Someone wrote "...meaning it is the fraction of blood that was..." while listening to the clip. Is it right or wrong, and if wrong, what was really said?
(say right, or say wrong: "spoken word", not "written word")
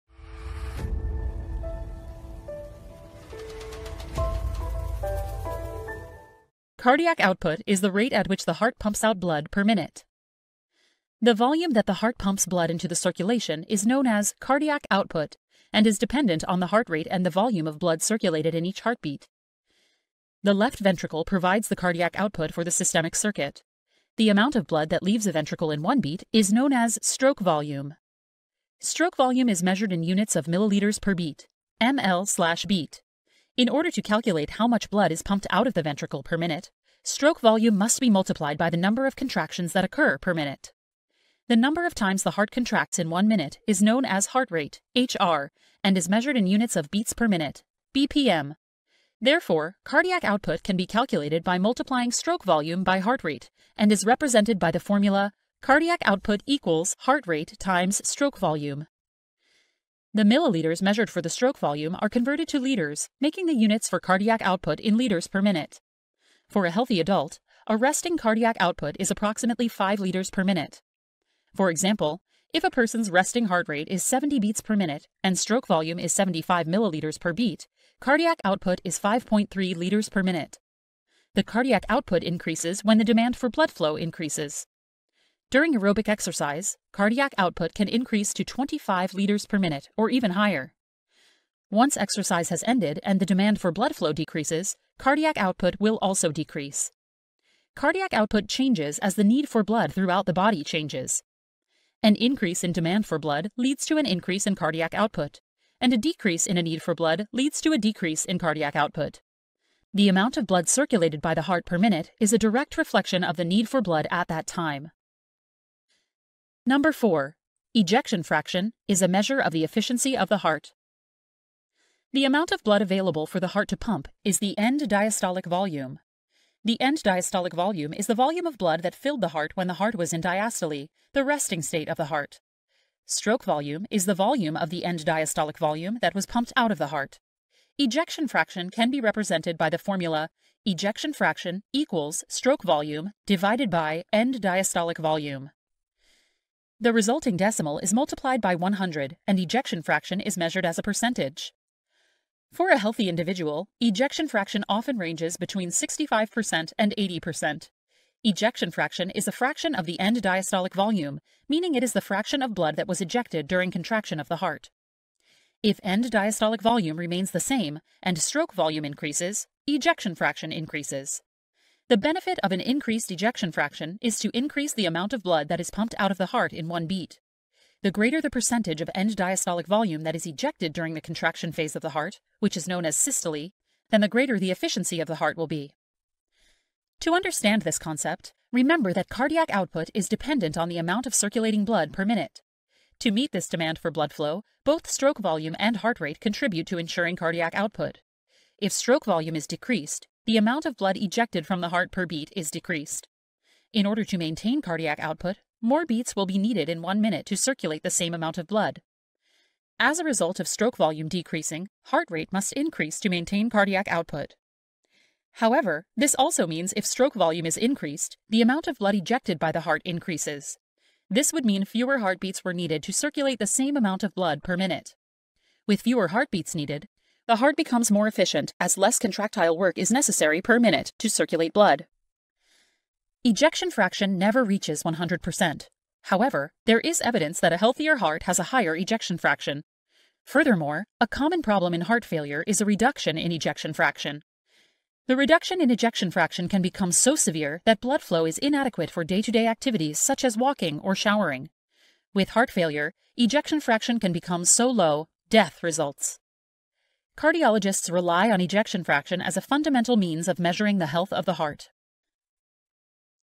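right.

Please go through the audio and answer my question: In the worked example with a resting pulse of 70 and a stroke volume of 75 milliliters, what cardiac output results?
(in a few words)
5.3 liters per minute.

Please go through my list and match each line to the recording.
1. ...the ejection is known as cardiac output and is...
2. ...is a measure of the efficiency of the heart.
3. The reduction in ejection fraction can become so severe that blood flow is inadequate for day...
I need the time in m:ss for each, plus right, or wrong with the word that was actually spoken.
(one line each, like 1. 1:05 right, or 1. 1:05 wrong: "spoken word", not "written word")
1. 0:12 wrong: "circulation", not "ejection"
2. 1:58 right
3. 4:05 right.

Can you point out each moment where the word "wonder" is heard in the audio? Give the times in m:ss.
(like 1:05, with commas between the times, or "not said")
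not said.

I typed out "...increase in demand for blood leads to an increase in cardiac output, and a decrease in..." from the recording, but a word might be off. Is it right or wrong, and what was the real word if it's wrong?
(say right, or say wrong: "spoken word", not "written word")
right.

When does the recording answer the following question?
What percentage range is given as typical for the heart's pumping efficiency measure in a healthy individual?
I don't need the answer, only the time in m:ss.
2:35.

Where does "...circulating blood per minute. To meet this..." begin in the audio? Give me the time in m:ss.
3:11.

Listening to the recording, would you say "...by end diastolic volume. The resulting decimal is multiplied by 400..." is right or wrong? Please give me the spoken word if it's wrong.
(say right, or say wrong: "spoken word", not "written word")
wrong: "100", not "400".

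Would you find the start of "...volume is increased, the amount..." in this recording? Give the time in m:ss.
3:37.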